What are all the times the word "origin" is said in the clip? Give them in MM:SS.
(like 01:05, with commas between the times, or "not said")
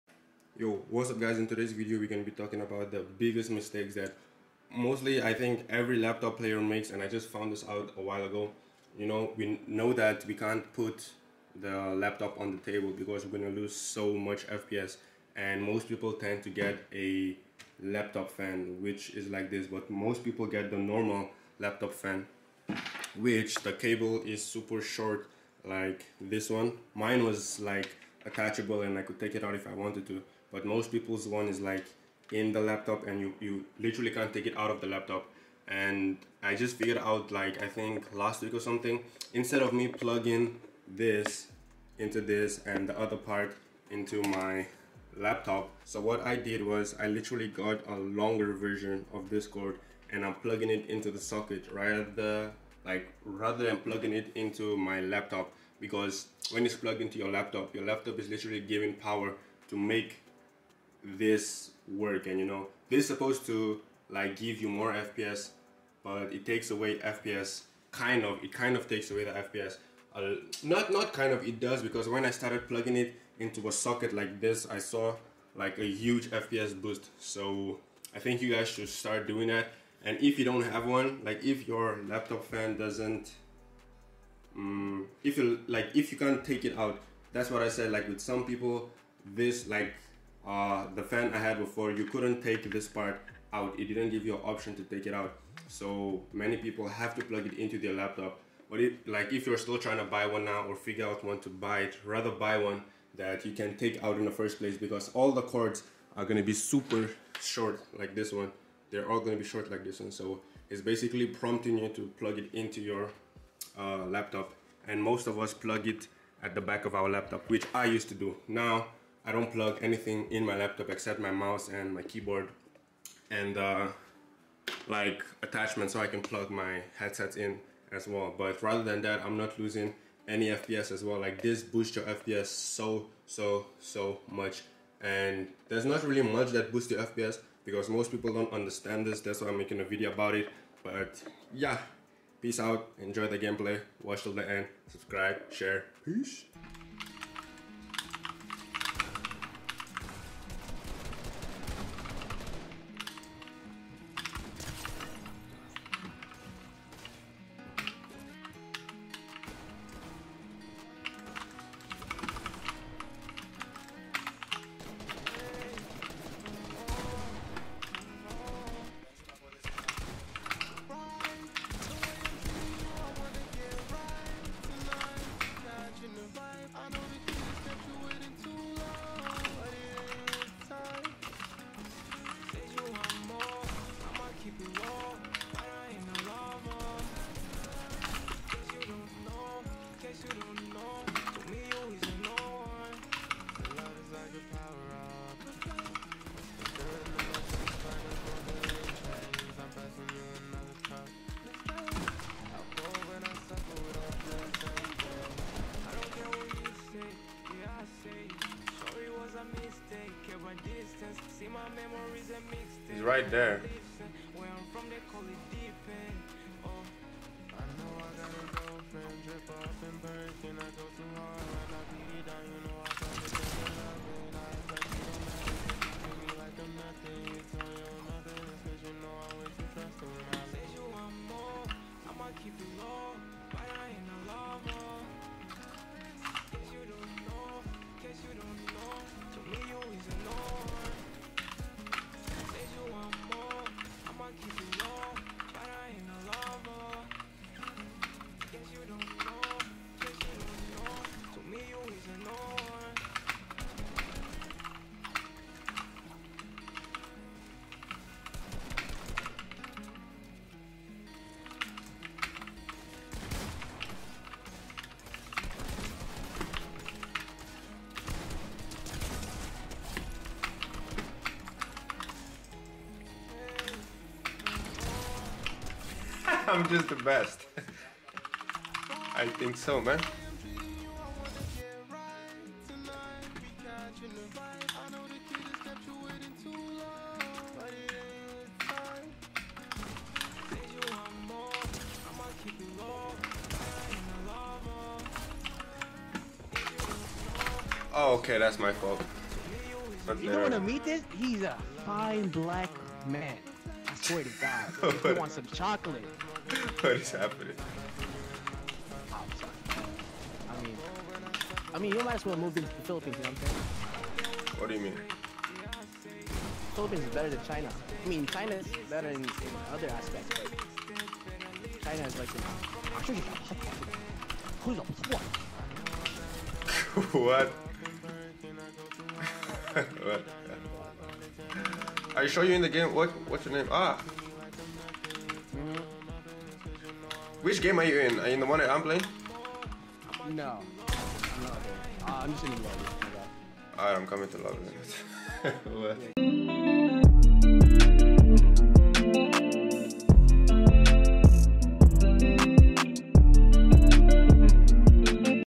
not said.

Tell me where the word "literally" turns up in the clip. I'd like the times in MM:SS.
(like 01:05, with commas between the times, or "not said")
00:33, 00:47, 00:58.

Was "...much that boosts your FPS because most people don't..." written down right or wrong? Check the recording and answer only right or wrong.
right.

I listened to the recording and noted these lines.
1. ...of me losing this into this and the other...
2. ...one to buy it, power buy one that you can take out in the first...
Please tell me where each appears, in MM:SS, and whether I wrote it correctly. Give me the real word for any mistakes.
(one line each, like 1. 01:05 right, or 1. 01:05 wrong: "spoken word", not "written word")
1. 00:39 wrong: "plugging", not "losing"
2. 01:41 wrong: "rather", not "power".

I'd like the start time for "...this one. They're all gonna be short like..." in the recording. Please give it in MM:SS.
01:48.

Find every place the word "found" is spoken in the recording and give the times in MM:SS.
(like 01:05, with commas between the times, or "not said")
00:07.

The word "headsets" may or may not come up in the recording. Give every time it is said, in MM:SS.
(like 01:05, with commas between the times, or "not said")
02:06.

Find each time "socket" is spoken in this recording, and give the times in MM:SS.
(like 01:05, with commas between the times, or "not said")
00:51, 01:13.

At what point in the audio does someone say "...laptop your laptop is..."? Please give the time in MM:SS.
00:57.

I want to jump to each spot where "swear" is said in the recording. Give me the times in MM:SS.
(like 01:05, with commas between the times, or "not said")
05:04.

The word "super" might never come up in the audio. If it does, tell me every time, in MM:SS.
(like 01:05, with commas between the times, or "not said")
00:24, 01:46.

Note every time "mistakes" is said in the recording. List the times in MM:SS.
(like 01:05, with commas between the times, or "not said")
00:03.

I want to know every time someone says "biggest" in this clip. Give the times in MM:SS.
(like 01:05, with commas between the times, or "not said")
00:03.